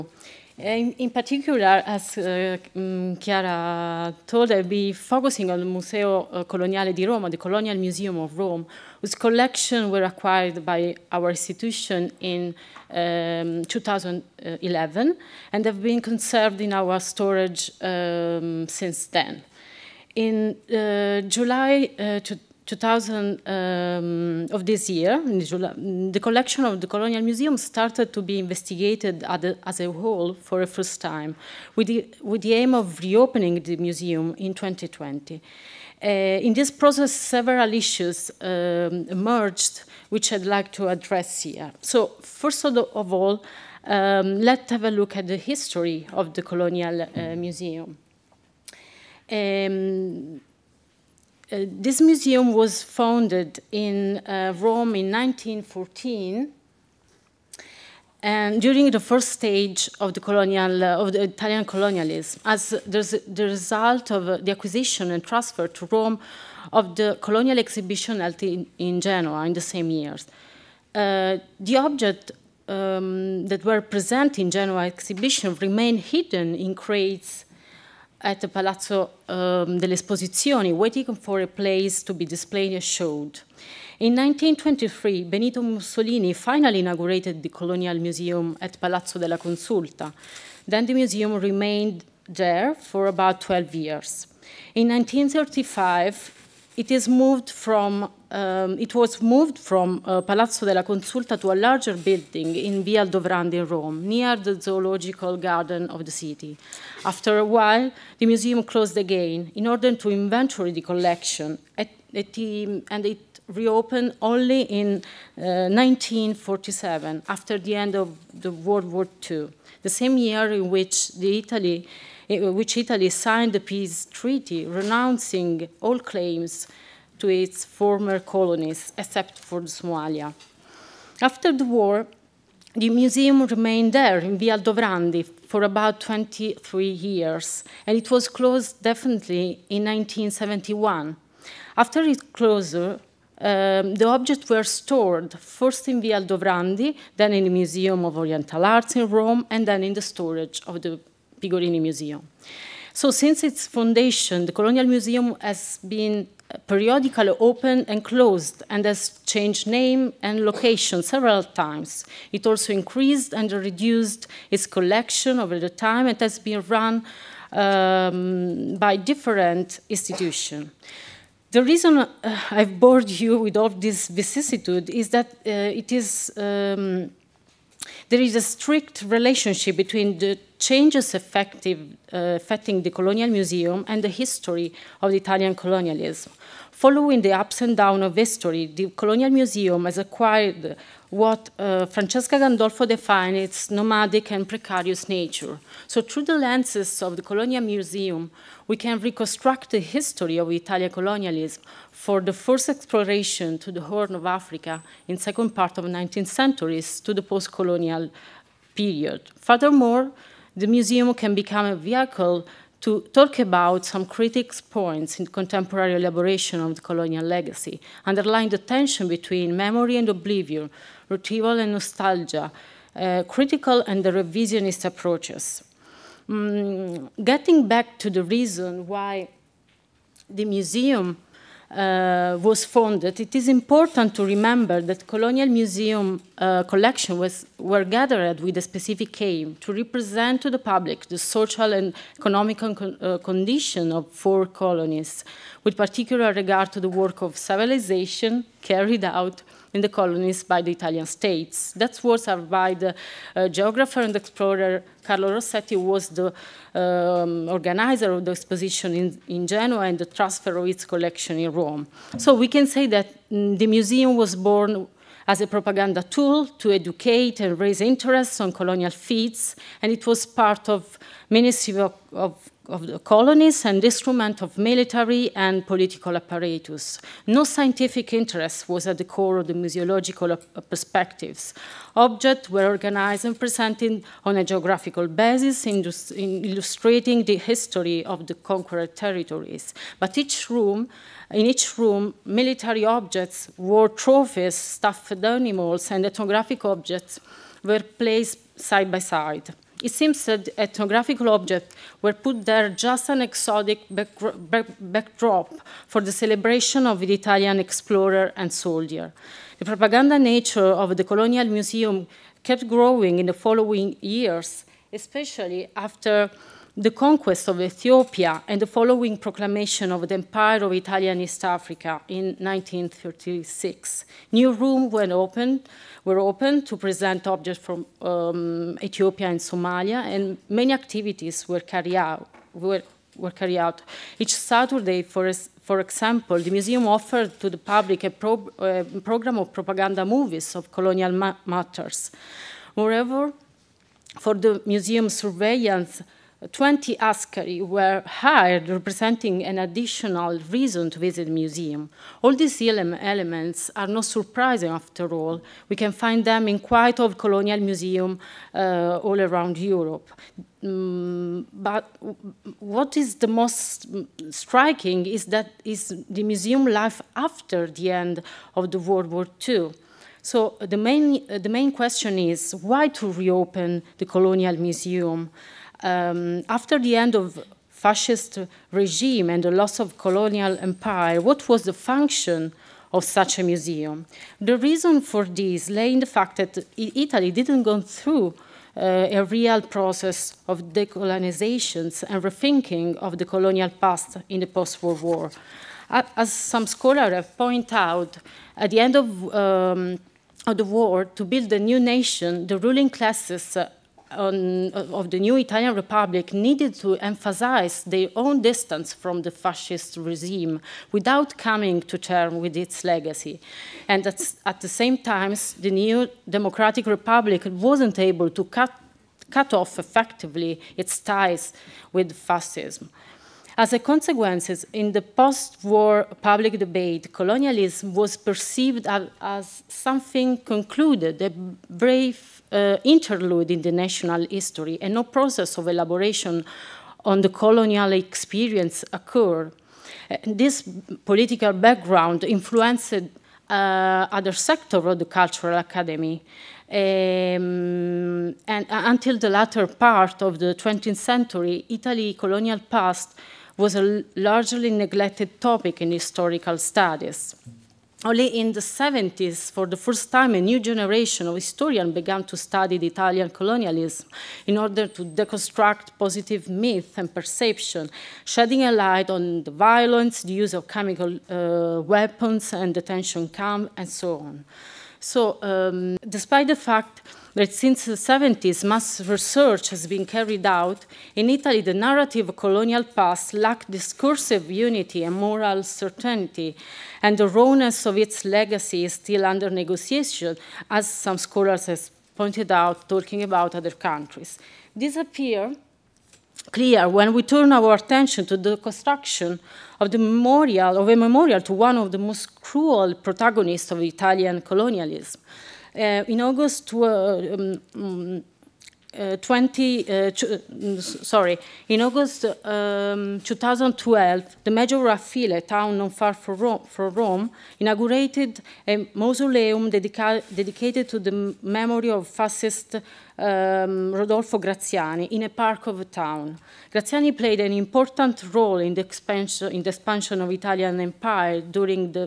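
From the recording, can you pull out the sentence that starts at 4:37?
No scientific interest was at the core of the museological perspectives.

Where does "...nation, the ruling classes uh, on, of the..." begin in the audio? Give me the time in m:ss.
6:41.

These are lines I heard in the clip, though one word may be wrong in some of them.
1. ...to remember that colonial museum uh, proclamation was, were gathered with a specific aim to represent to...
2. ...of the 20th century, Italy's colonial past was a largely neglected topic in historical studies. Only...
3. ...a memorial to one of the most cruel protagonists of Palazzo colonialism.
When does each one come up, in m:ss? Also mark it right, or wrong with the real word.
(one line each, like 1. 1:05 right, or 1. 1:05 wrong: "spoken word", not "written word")
1. 3:54 wrong: "collection", not "proclamation"
2. 7:30 right
3. 8:20 wrong: "Italian", not "Palazzo".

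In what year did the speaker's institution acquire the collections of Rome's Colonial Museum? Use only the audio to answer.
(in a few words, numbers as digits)
2011.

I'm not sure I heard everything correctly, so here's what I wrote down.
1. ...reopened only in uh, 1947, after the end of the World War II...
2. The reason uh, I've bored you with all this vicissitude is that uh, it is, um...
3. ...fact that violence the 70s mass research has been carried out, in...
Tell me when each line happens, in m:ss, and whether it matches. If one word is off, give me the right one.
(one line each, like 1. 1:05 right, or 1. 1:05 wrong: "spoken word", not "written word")
1. 1:53 right
2. 2:51 right
3. 7:56 wrong: "since", not "violence".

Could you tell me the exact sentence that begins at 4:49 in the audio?
But each room, in each room, military objects, war trophies, stuffed animals, and ethnographic objects were placed side by side.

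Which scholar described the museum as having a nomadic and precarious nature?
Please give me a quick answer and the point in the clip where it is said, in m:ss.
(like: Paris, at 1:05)
Francesca Gandolfo, at 3:11.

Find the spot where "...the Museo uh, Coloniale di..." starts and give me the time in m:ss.
0:05.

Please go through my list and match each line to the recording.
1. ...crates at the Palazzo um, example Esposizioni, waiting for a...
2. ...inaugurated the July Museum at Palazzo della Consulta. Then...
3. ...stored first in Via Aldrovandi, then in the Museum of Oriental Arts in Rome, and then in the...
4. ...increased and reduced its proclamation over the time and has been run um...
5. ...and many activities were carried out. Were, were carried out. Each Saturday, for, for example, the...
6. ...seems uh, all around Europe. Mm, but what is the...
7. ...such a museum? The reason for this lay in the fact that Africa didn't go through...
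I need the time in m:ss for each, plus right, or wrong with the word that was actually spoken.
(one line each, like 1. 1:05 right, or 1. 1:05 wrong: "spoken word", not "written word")
1. 1:16 wrong: "delle", not "example"
2. 1:26 wrong: "Colonial", not "July"
3. 2:24 right
4. 2:42 wrong: "collection", not "proclamation"
5. 5:30 right
6. 5:57 wrong: "museums", not "seems"
7. 6:23 wrong: "Italy", not "Africa".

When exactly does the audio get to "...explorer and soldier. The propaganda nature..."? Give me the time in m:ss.
5:07.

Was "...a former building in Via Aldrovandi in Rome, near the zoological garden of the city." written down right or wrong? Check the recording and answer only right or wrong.
wrong.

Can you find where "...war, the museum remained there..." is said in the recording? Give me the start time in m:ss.
2:11.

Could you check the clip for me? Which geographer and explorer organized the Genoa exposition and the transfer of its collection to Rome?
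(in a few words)
Carlo Rossetti.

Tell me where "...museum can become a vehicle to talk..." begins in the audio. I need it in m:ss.
3:30.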